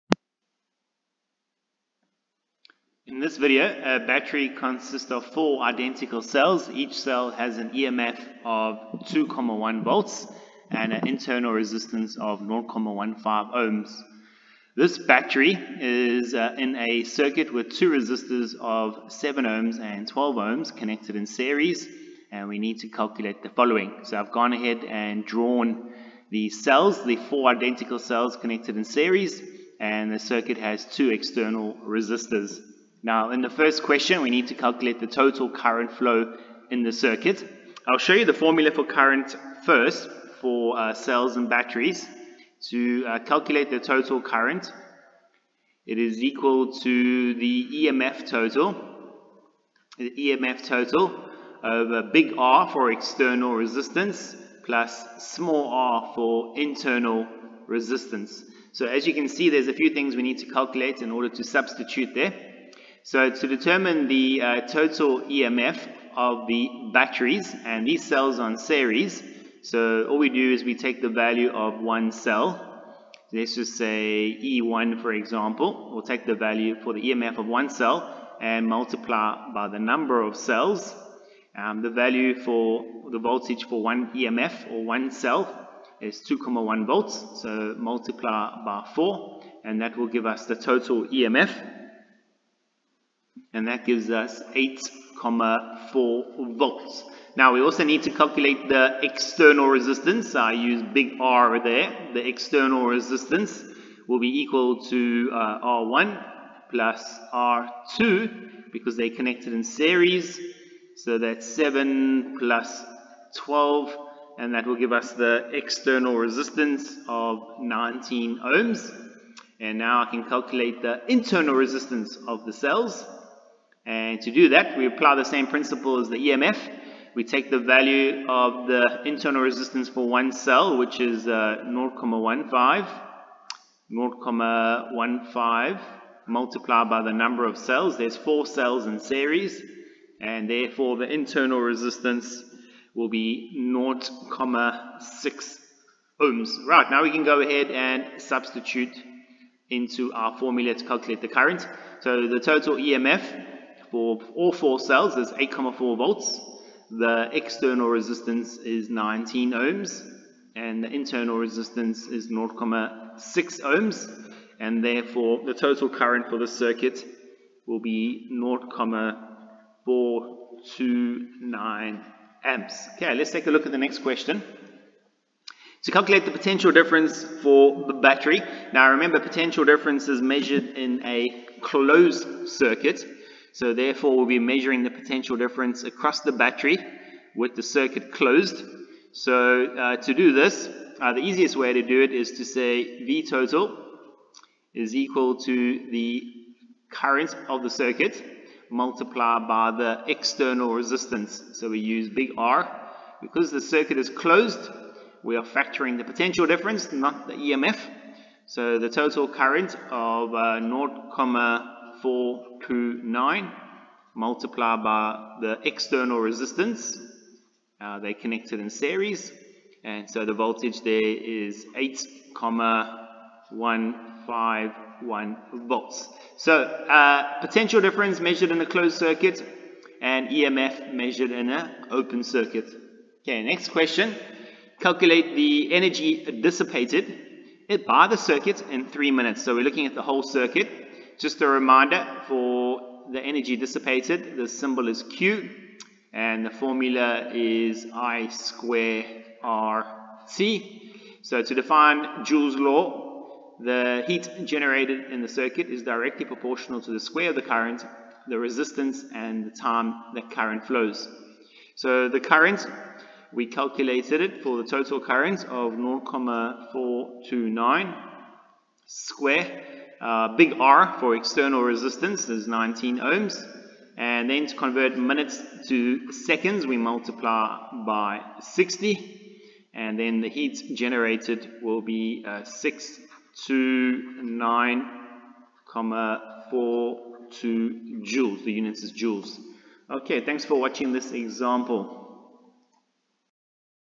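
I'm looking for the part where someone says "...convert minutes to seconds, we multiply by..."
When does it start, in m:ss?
4:34.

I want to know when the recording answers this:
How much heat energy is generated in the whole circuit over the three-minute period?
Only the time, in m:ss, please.
4:42.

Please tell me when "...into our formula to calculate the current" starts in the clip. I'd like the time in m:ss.
2:29.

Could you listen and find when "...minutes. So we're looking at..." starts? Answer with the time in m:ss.
3:59.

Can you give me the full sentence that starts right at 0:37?
I'll show you the formula for current first for uh, cells and batteries.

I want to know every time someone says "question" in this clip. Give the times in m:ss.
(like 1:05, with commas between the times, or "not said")
0:33, 2:53, 3:53.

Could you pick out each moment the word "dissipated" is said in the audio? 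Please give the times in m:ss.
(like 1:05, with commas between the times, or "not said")
3:56, 4:03.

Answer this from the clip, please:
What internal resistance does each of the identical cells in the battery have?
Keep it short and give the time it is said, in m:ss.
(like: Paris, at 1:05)
0.15 ohms, at 0:12.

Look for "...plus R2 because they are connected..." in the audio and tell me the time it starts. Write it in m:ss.
1:46.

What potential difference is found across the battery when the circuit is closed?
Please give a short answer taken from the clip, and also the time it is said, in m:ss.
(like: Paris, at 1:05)
8.151 volts, at 3:41.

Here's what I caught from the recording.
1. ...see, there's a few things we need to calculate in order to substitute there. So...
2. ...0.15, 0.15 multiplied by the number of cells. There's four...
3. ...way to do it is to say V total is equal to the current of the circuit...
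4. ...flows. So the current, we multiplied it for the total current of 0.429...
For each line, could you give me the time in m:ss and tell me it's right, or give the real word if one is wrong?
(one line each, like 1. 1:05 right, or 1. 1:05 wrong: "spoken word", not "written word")
1. 0:59 right
2. 2:11 right
3. 3:11 right
4. 4:20 wrong: "calculated", not "multiplied".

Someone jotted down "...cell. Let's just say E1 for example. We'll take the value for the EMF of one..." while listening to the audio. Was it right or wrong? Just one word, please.
right.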